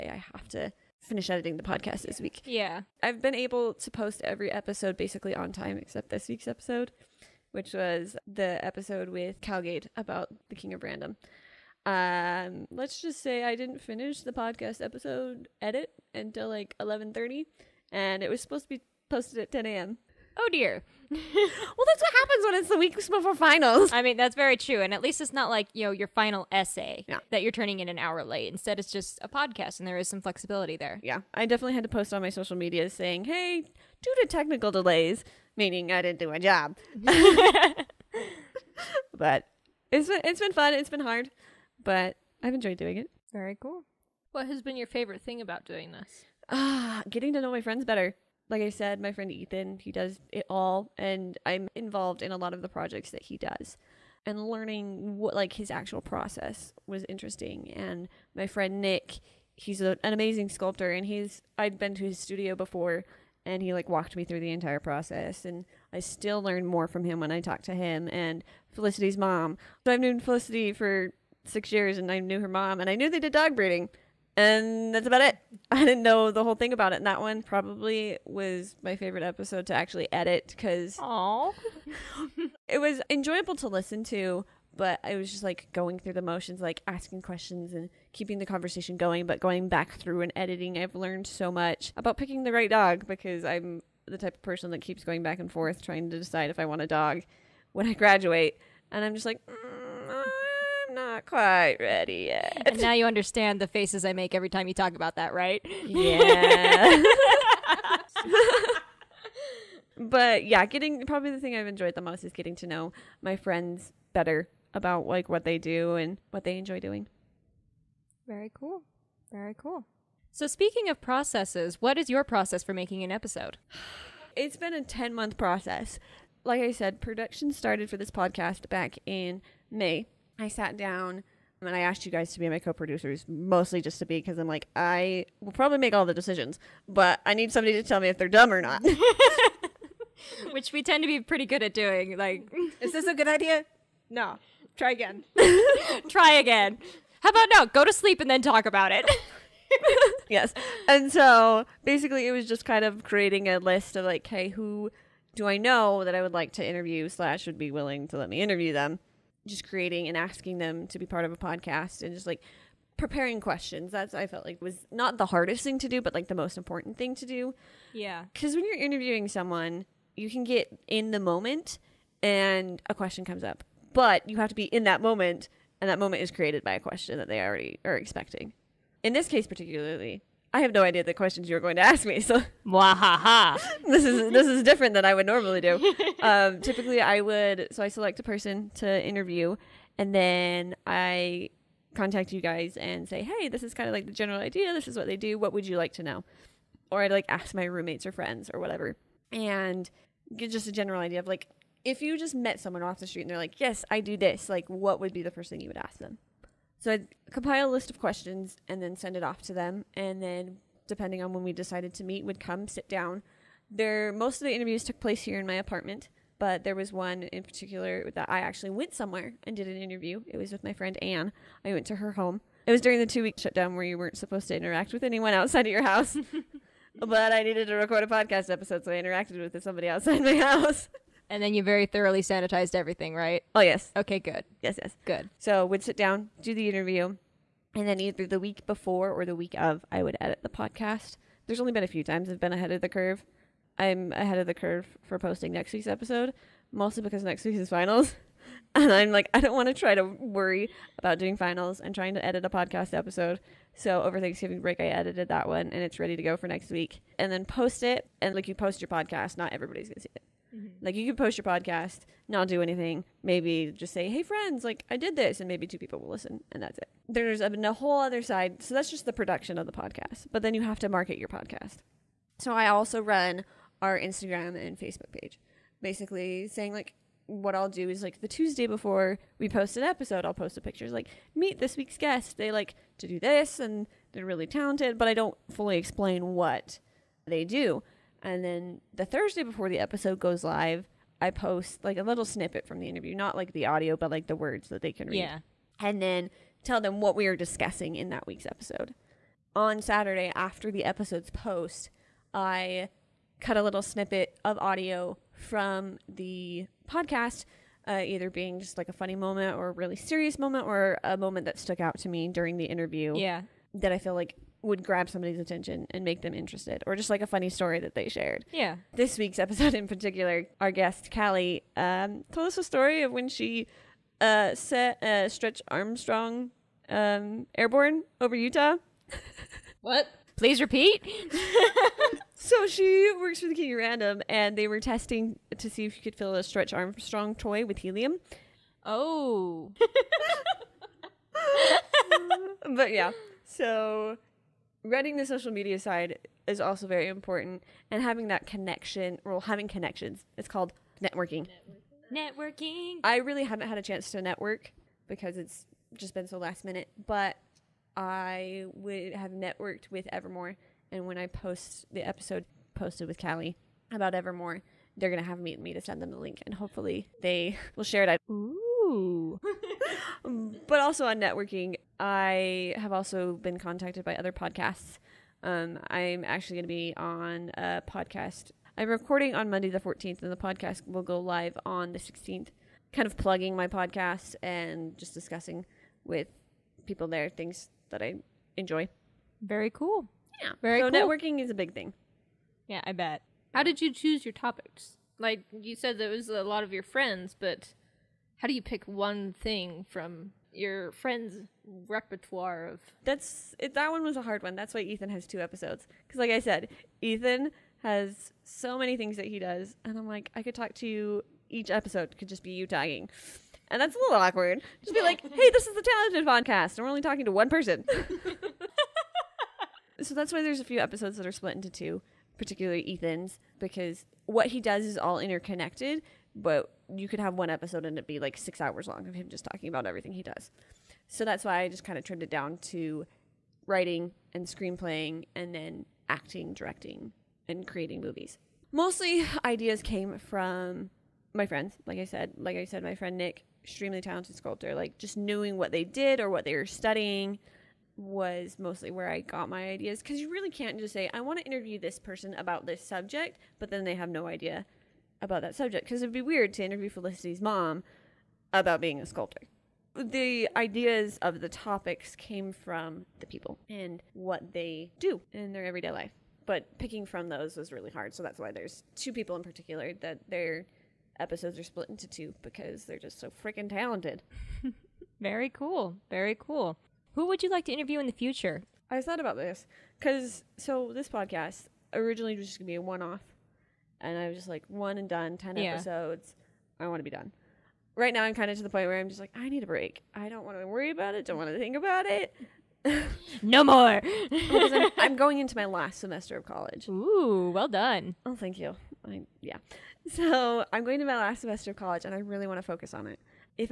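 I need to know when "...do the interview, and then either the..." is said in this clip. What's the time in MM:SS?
03:56.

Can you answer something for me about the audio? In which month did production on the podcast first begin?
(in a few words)
May.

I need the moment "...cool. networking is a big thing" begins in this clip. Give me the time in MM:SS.
06:30.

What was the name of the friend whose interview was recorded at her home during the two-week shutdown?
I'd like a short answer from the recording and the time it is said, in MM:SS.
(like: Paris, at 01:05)
Anne, at 03:41.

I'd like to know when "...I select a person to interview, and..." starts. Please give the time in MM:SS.
03:07.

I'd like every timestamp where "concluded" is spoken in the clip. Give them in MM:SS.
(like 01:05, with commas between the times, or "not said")
not said.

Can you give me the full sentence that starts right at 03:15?
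What would you like to know?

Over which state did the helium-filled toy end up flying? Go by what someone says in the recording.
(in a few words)
Utah.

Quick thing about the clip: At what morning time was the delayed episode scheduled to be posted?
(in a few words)
10 a.m.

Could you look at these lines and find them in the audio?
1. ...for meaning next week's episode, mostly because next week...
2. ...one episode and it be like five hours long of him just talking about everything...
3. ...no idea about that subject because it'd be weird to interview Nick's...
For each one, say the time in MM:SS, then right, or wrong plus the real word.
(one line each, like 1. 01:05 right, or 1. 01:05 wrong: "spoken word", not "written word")
1. 04:05 wrong: "posting", not "meaning"
2. 07:07 wrong: "six", not "five"
3. 07:34 wrong: "Felicity", not "Nick".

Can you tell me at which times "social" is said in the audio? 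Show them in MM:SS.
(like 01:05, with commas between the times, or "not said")
00:32, 05:45.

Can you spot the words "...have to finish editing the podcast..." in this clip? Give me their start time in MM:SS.
00:00.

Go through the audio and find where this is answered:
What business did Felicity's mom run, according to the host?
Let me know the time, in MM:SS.
01:13.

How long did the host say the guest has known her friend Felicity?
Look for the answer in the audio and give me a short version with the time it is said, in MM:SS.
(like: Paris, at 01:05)
6 years, at 01:11.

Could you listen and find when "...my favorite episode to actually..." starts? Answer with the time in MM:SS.
01:18.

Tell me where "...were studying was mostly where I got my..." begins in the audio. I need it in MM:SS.
07:26.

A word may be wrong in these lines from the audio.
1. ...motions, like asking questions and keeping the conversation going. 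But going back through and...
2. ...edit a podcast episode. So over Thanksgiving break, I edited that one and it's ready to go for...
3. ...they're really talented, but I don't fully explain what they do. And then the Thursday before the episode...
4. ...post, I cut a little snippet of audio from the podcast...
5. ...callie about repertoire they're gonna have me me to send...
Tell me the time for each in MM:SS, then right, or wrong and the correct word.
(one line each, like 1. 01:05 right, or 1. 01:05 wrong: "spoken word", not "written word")
1. 01:26 right
2. 04:12 right
3. 04:44 right
4. 05:01 right
5. 06:03 wrong: "evermore", not "repertoire".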